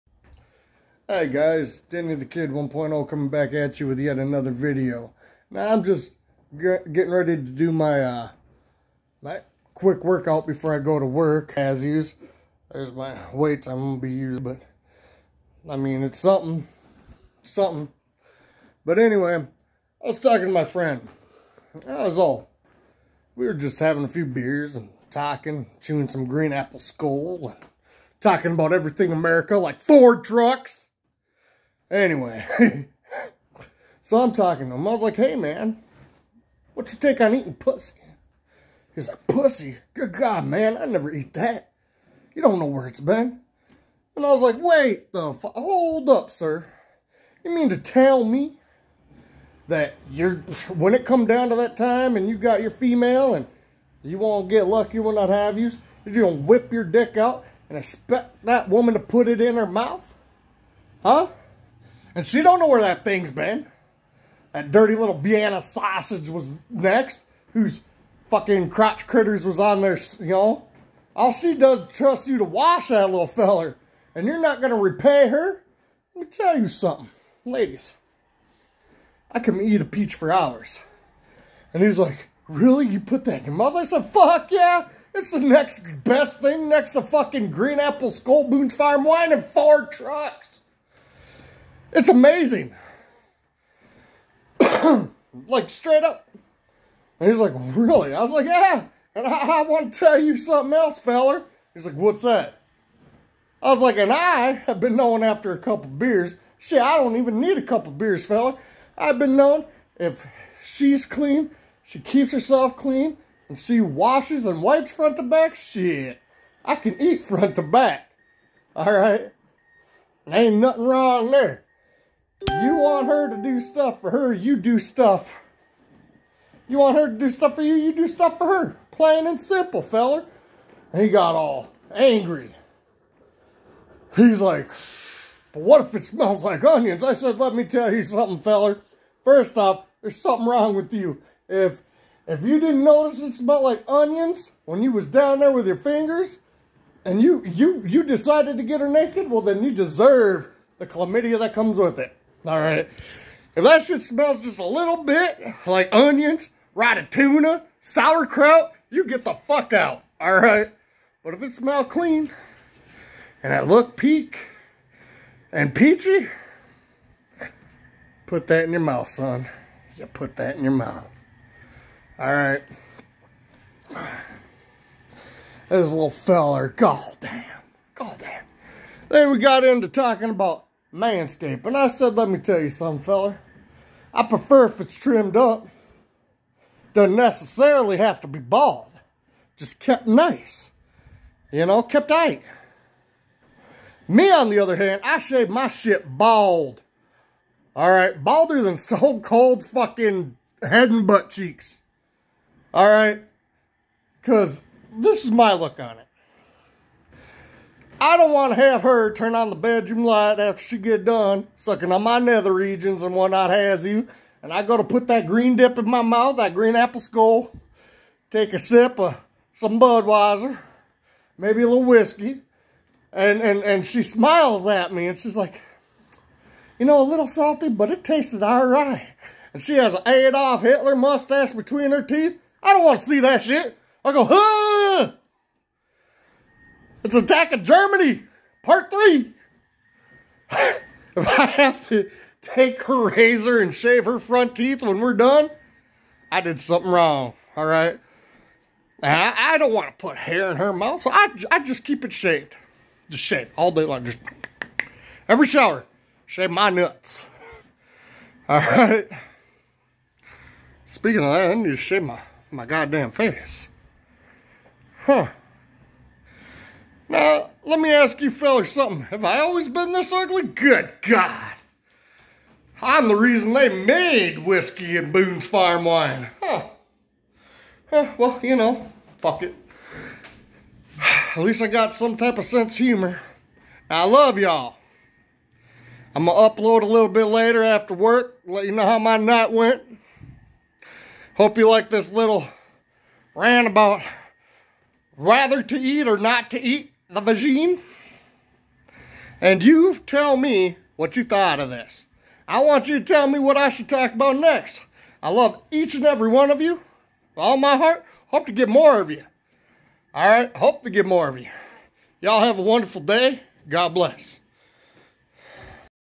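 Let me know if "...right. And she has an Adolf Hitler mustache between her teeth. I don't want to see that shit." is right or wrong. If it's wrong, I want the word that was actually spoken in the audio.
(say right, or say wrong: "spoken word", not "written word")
right.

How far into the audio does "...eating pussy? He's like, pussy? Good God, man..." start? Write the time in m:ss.
0:37.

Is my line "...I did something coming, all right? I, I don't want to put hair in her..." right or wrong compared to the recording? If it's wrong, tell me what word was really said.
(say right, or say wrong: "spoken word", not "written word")
wrong: "wrong", not "coming".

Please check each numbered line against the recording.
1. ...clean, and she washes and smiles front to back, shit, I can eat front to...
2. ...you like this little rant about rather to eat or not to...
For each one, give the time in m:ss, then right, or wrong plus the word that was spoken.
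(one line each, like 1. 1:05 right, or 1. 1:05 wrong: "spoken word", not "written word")
1. 1:52 wrong: "wipes", not "smiles"
2. 4:51 right.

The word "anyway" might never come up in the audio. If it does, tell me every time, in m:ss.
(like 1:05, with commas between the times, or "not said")
0:18, 0:31.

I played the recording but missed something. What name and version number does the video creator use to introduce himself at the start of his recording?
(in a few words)
Danny the Kid 1.0.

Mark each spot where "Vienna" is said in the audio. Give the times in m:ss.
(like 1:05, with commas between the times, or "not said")
1:05.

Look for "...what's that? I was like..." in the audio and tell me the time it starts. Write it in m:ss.
1:41.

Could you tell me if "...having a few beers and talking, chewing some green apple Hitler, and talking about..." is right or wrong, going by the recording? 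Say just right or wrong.
wrong.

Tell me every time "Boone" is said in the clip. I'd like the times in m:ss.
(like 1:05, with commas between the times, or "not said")
1:28, 4:35.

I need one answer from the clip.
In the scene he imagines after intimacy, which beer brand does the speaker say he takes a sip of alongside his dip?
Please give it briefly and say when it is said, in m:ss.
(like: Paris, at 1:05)
Budweiser, at 3:39.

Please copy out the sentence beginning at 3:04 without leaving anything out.
I prefer if it's trimmed up.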